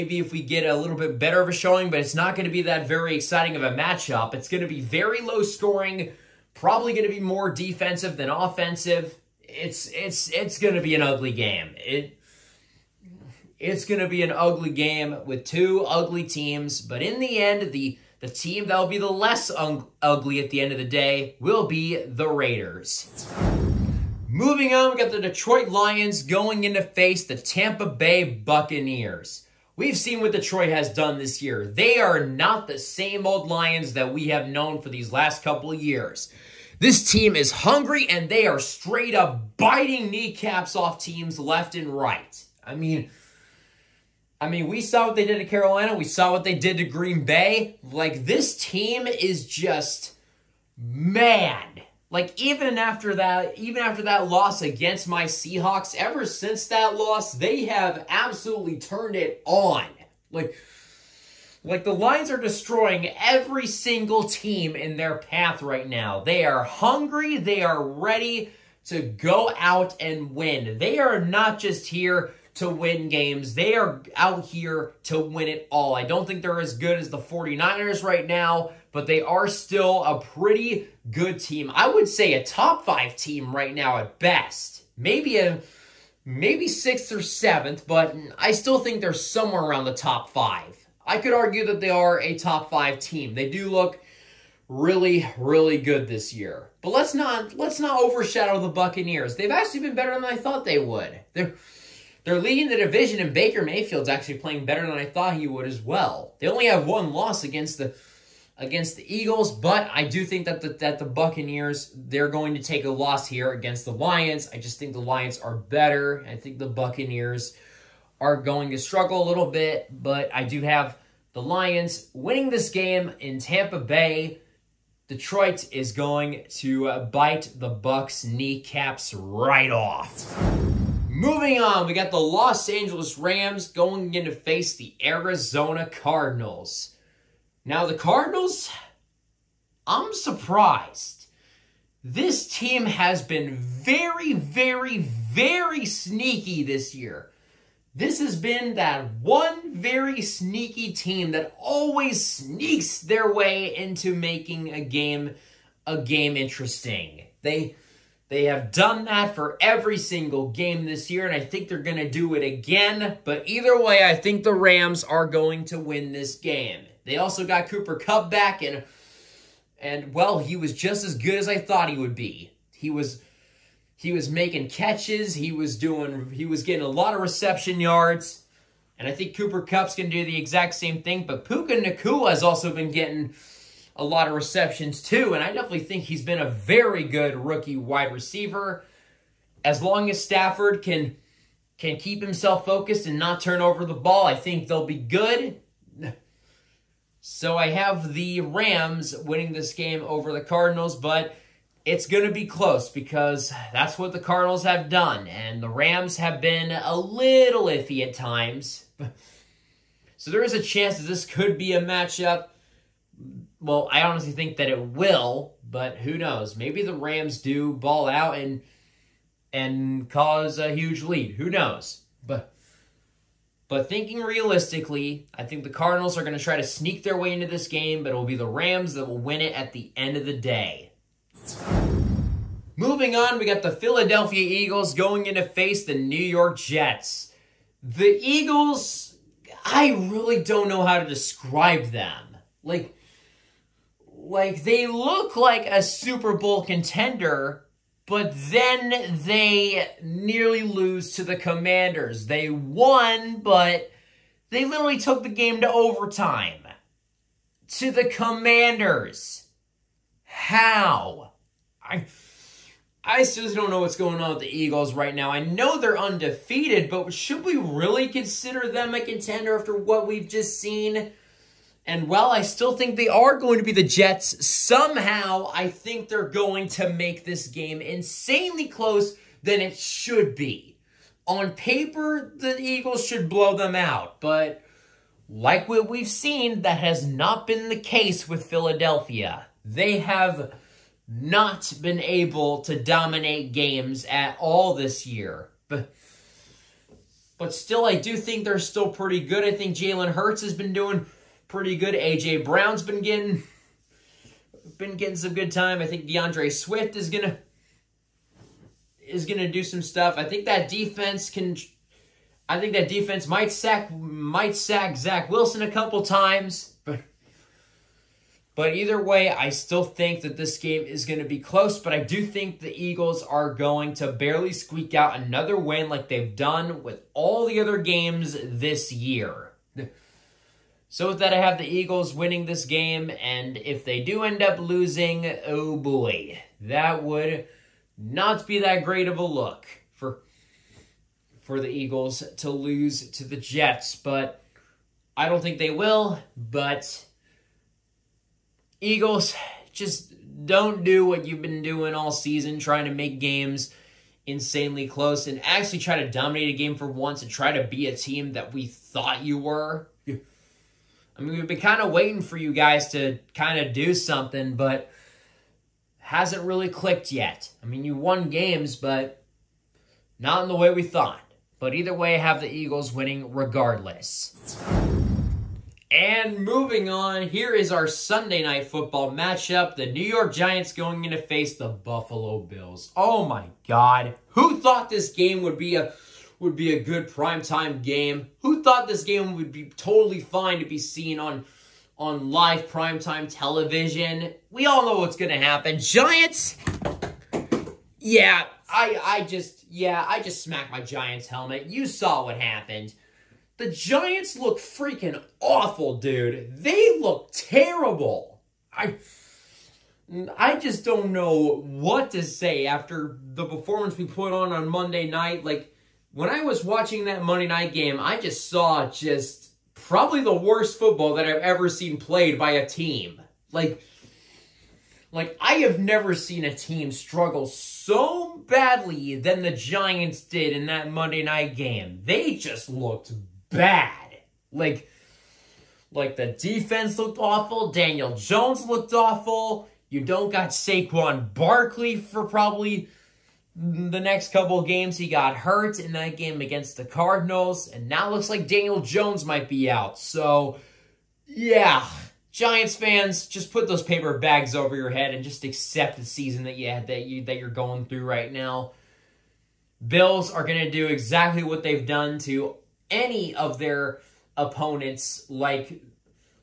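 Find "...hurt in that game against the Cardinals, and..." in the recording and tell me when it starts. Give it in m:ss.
7:25.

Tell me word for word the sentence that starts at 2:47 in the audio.
They also got Cooper Kupp back, and, and well, he was just as good as I thought he would be.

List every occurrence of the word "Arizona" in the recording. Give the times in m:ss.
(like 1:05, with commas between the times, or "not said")
2:15.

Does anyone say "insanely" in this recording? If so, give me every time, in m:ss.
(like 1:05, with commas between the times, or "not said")
4:37, 5:54.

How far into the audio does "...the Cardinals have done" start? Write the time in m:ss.
3:24.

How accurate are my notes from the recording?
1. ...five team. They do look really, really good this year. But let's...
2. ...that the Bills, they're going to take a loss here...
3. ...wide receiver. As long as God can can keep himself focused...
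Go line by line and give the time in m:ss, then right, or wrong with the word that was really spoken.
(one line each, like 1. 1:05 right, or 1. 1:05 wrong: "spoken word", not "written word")
1. 1:32 right
2. 1:50 wrong: "Buccaneers", not "Bills"
3. 3:07 wrong: "Stafford", not "God".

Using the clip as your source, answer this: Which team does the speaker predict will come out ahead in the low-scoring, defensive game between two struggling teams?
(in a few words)
Raiders.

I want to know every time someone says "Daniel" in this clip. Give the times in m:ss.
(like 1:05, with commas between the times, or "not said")
7:17, 7:28.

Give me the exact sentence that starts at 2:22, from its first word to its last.
This team has been very, very, very sneaky this year.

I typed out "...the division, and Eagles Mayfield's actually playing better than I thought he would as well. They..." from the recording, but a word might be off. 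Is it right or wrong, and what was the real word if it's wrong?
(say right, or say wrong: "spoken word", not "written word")
wrong: "Baker", not "Eagles".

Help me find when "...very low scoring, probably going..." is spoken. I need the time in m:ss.
0:04.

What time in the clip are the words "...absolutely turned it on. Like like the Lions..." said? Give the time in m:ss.
0:58.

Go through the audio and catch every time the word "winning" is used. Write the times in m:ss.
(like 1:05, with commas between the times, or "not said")
2:02, 3:19, 5:32, 6:12.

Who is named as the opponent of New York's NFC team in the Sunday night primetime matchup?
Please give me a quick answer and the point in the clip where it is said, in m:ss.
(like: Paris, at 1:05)
Buffalo Bills, at 6:21.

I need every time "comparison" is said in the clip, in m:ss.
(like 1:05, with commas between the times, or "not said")
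not said.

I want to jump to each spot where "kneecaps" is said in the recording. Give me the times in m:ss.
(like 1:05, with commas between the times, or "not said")
0:40, 2:08.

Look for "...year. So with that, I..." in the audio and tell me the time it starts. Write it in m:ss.
5:28.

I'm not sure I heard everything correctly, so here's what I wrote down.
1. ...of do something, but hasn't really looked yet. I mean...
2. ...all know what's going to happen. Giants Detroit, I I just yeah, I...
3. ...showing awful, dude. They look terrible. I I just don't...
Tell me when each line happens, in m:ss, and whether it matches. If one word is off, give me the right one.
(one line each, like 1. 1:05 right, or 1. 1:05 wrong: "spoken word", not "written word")
1. 6:03 wrong: "clicked", not "looked"
2. 6:34 wrong: "Yeah", not "Detroit"
3. 6:44 wrong: "freaking", not "showing".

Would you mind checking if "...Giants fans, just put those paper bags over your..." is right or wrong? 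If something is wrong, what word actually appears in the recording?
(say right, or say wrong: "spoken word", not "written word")
right.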